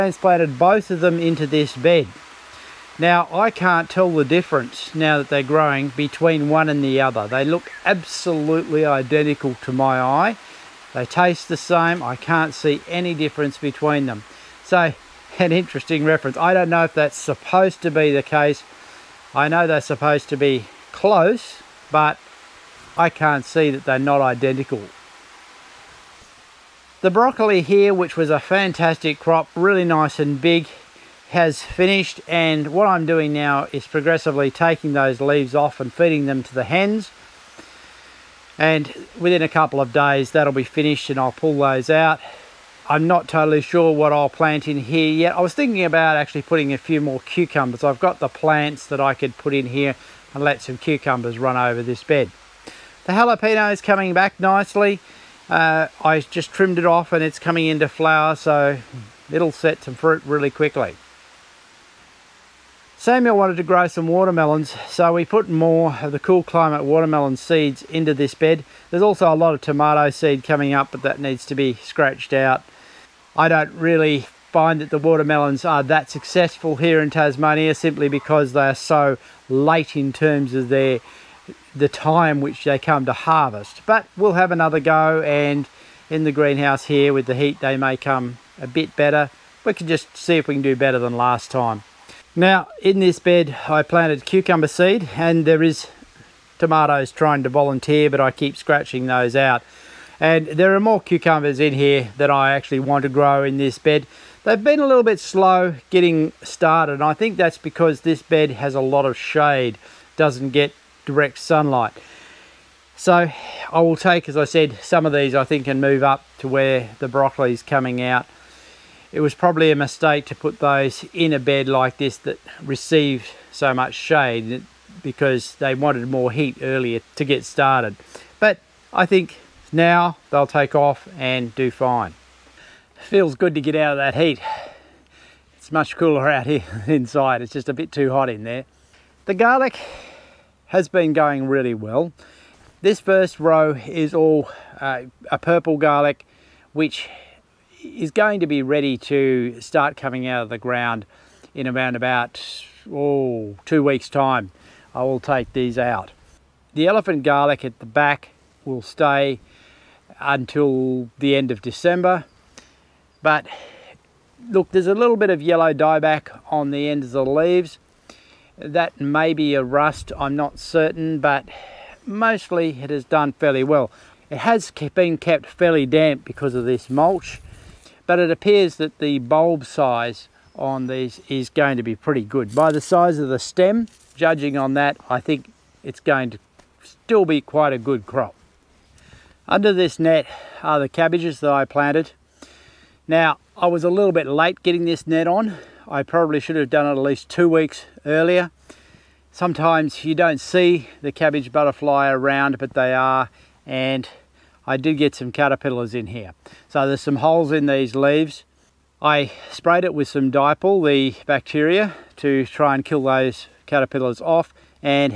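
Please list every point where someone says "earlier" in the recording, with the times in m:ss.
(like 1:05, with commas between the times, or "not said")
2:06, 3:18.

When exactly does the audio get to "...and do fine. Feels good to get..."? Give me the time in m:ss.
2:11.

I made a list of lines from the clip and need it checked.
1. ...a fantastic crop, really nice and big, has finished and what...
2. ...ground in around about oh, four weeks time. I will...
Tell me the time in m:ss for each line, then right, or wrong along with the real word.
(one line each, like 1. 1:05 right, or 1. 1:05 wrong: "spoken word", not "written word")
1. 0:28 right
2. 2:30 wrong: "two", not "four".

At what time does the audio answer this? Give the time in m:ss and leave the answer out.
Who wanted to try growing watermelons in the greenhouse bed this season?
1:02.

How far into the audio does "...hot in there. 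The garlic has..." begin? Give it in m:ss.
2:18.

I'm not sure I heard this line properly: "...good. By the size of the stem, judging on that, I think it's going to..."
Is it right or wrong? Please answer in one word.
right.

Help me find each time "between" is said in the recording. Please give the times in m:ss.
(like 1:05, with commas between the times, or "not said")
0:05, 0:13.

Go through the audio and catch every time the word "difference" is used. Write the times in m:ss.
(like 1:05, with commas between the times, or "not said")
0:04, 0:13.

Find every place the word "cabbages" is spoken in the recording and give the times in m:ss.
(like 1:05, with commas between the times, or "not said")
3:10, 3:21.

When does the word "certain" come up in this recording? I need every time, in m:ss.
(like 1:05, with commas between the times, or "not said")
2:50.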